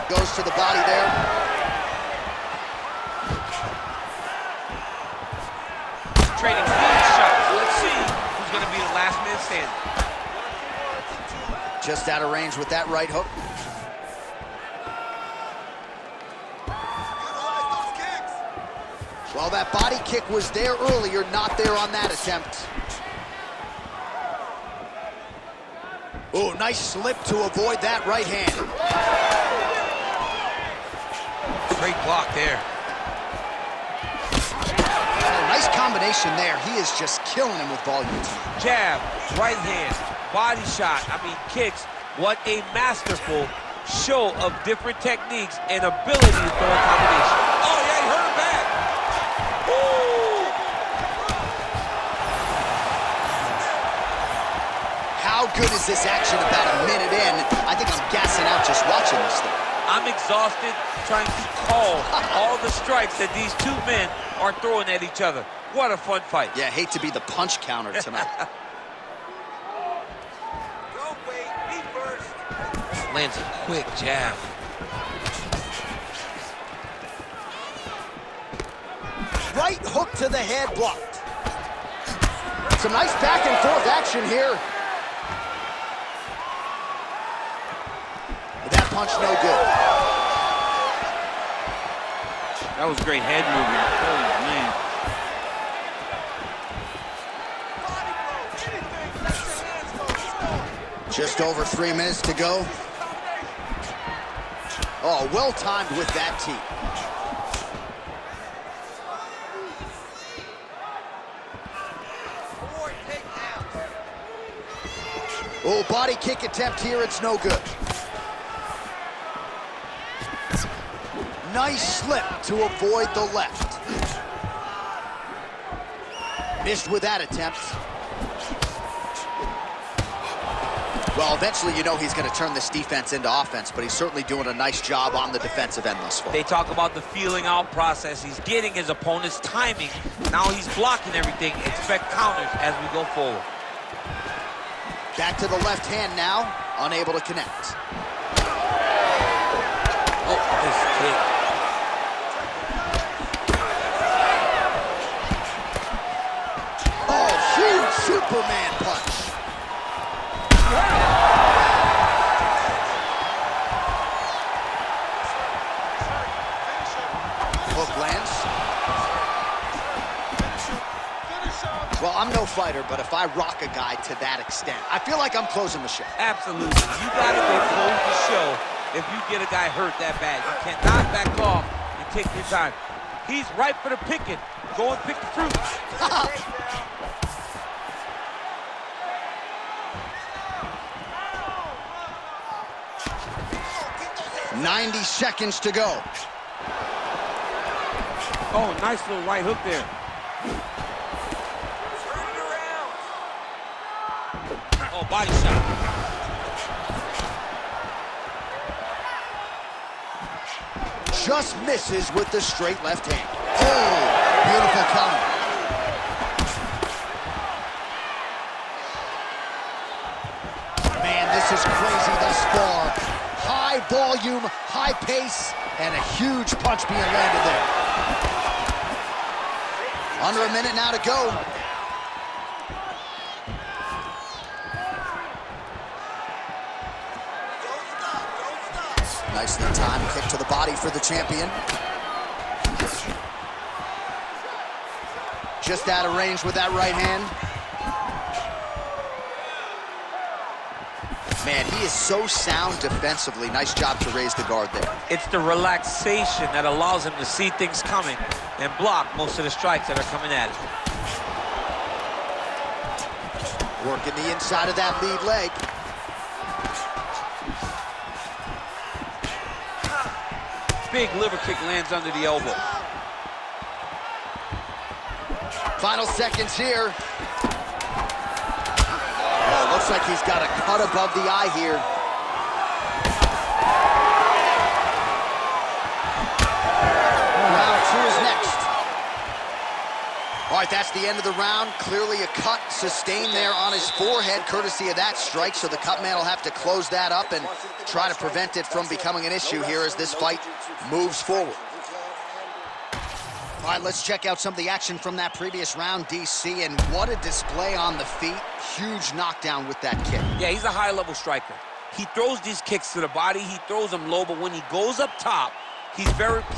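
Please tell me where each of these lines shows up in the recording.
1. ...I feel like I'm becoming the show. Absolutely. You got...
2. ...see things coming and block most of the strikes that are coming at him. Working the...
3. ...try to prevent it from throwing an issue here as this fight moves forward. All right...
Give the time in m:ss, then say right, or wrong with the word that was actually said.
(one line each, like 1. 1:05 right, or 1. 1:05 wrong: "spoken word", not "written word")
1. 2:54 wrong: "closing", not "becoming"
2. 4:17 right
3. 4:57 wrong: "becoming", not "throwing".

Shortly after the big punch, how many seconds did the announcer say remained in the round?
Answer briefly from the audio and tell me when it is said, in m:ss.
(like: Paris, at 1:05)
90, at 3:14.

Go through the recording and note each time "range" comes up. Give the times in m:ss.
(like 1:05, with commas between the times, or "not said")
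0:12, 4:06.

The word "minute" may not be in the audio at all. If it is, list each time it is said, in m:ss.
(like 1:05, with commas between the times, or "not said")
0:56, 1:41, 3:50.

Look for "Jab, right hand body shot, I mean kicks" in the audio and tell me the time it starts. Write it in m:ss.
0:38.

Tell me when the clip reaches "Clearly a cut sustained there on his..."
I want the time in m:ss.
4:51.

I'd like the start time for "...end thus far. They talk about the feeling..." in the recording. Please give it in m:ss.
2:15.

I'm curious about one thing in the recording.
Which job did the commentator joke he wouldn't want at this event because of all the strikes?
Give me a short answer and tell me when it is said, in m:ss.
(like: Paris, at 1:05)
Punch counter, at 1:07.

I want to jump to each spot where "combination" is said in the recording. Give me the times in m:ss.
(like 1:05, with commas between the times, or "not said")
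0:35, 0:46.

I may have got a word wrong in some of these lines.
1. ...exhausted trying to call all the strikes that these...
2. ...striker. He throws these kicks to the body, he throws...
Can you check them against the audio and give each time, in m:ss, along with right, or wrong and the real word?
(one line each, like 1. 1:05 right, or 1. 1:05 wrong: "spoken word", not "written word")
1. 1:00 right
2. 5:11 right.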